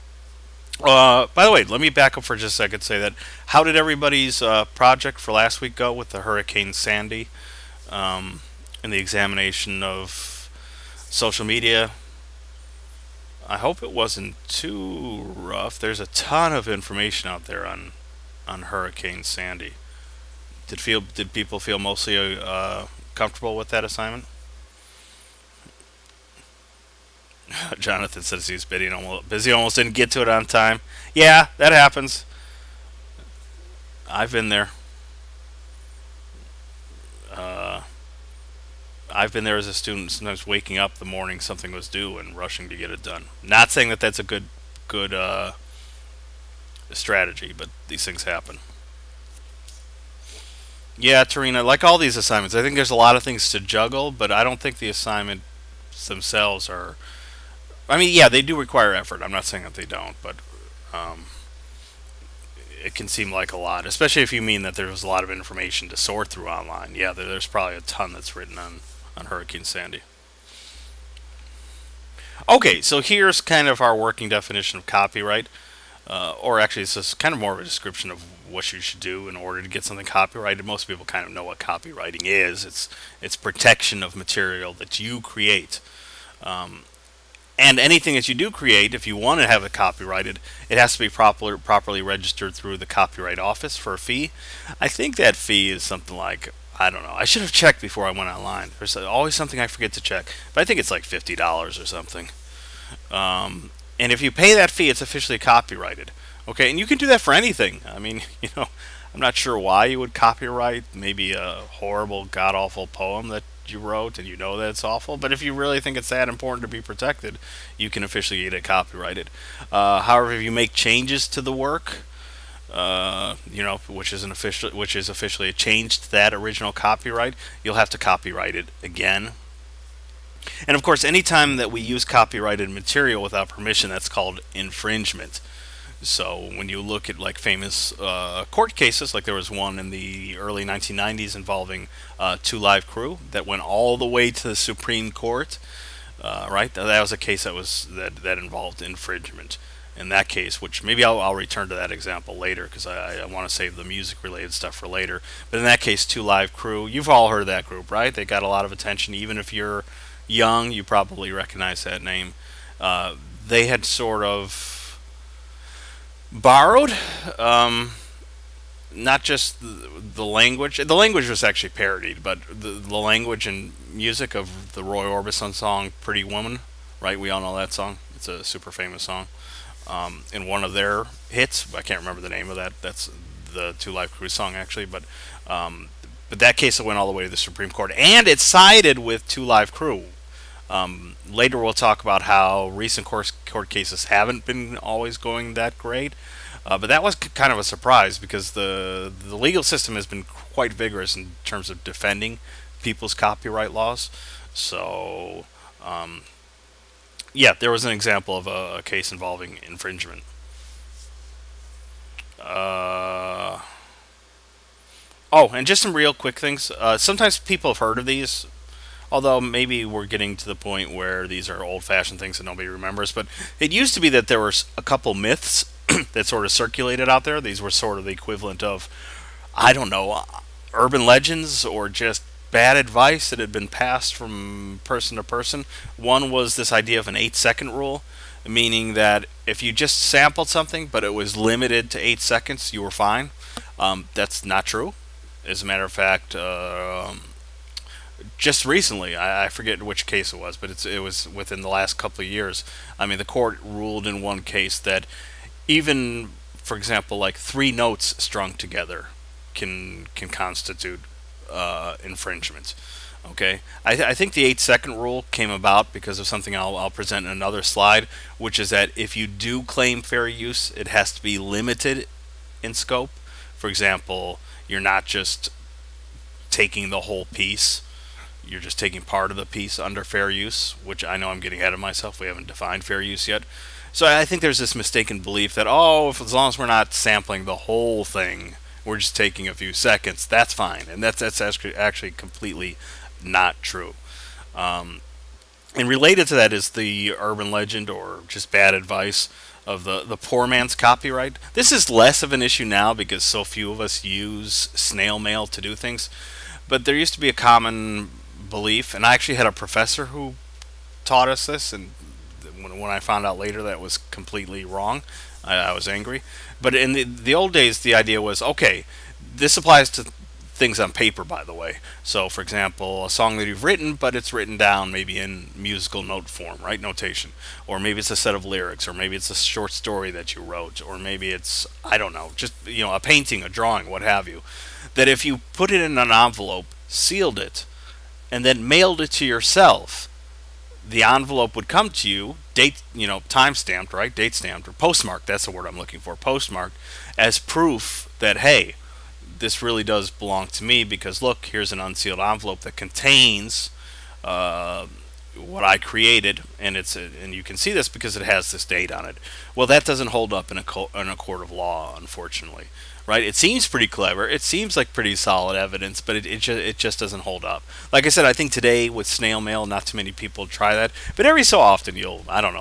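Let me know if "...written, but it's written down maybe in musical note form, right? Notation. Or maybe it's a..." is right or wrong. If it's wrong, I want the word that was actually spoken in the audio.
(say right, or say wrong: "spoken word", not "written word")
right.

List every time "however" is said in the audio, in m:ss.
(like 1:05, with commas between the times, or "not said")
2:00.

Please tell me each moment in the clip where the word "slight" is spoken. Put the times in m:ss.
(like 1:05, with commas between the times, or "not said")
not said.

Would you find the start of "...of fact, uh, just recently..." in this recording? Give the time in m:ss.
4:05.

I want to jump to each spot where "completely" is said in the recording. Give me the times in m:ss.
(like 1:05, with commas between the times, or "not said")
4:52, 5:13.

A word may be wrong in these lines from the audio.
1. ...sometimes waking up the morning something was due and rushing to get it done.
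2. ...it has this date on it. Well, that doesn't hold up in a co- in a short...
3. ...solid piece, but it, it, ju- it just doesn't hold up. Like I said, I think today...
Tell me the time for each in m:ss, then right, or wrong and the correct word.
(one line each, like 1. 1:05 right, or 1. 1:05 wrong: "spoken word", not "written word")
1. 0:40 right
2. 5:58 wrong: "court", not "short"
3. 6:05 wrong: "evidence", not "piece".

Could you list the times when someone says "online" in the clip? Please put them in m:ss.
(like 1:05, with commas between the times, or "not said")
1:06, 1:38.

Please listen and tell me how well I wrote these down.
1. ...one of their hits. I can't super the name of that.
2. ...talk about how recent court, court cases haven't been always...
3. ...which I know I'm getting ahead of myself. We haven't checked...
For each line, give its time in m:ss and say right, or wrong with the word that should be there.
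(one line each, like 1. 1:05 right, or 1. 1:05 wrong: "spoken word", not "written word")
1. 3:00 wrong: "remember", not "super"
2. 3:11 right
3. 4:40 wrong: "defined", not "checked".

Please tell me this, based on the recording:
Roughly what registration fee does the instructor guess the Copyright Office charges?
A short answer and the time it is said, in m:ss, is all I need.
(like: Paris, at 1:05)
$50, at 1:41.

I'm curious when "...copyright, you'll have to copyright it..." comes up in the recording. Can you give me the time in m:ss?
2:06.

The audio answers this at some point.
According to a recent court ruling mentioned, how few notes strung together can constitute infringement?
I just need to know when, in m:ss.
4:17.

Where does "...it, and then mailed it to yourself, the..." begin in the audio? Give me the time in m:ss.
5:37.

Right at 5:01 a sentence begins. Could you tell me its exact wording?
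This is less of an issue now because so few of us use snail mail to do things.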